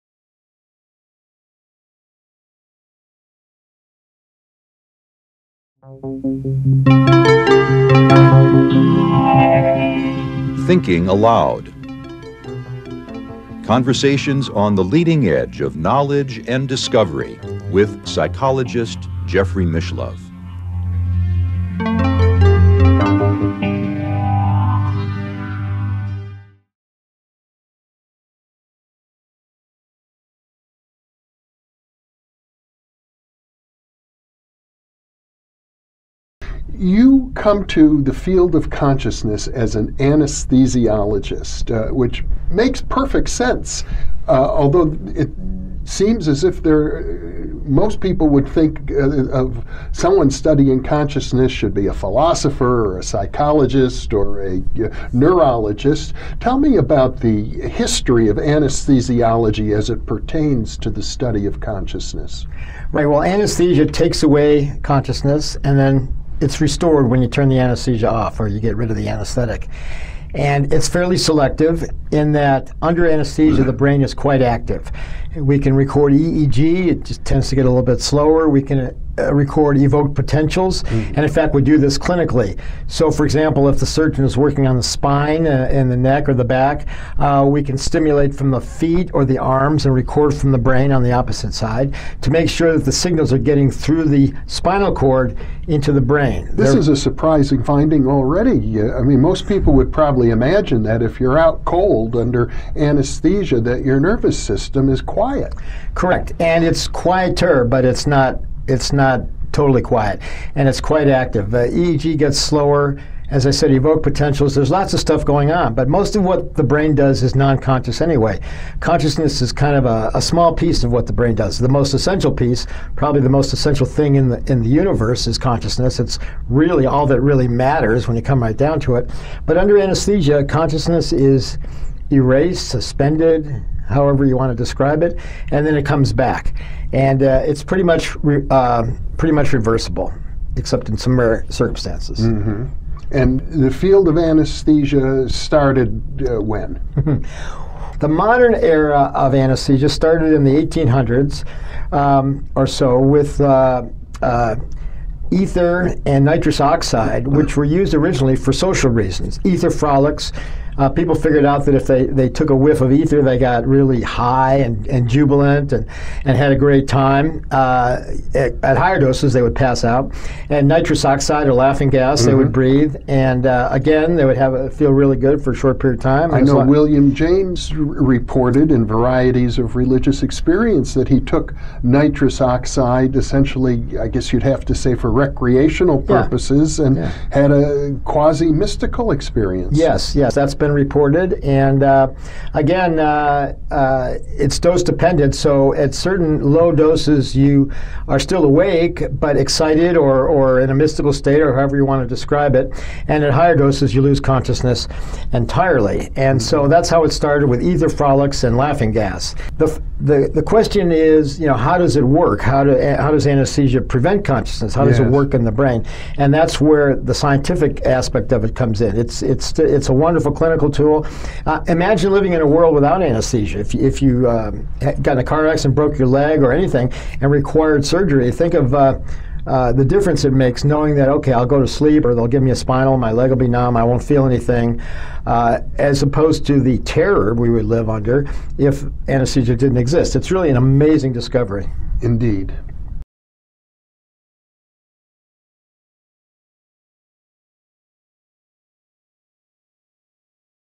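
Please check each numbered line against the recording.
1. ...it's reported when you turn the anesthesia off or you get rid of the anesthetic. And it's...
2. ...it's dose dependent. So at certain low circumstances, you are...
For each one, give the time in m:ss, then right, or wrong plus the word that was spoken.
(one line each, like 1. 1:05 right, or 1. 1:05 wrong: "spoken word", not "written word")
1. 1:06 wrong: "restored", not "reported"
2. 3:14 wrong: "doses", not "circumstances".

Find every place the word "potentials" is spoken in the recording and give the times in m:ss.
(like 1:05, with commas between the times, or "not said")
1:20, 1:54.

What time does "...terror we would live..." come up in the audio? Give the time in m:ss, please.
3:56.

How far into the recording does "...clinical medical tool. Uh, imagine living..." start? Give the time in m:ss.
3:40.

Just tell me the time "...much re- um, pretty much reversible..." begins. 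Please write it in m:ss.
2:17.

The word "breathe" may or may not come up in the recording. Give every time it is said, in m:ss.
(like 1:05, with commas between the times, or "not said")
2:52.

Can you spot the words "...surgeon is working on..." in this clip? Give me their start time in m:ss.
1:23.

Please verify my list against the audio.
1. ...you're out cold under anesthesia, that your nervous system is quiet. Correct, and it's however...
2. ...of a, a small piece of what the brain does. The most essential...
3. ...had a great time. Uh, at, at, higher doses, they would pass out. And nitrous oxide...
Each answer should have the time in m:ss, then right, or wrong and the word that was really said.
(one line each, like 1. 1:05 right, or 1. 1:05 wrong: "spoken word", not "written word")
1. 1:41 wrong: "quieter", not "however"
2. 1:59 right
3. 2:46 right.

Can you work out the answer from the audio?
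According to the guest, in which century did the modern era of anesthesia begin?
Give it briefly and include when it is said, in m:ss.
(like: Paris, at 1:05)
1800s, at 2:30.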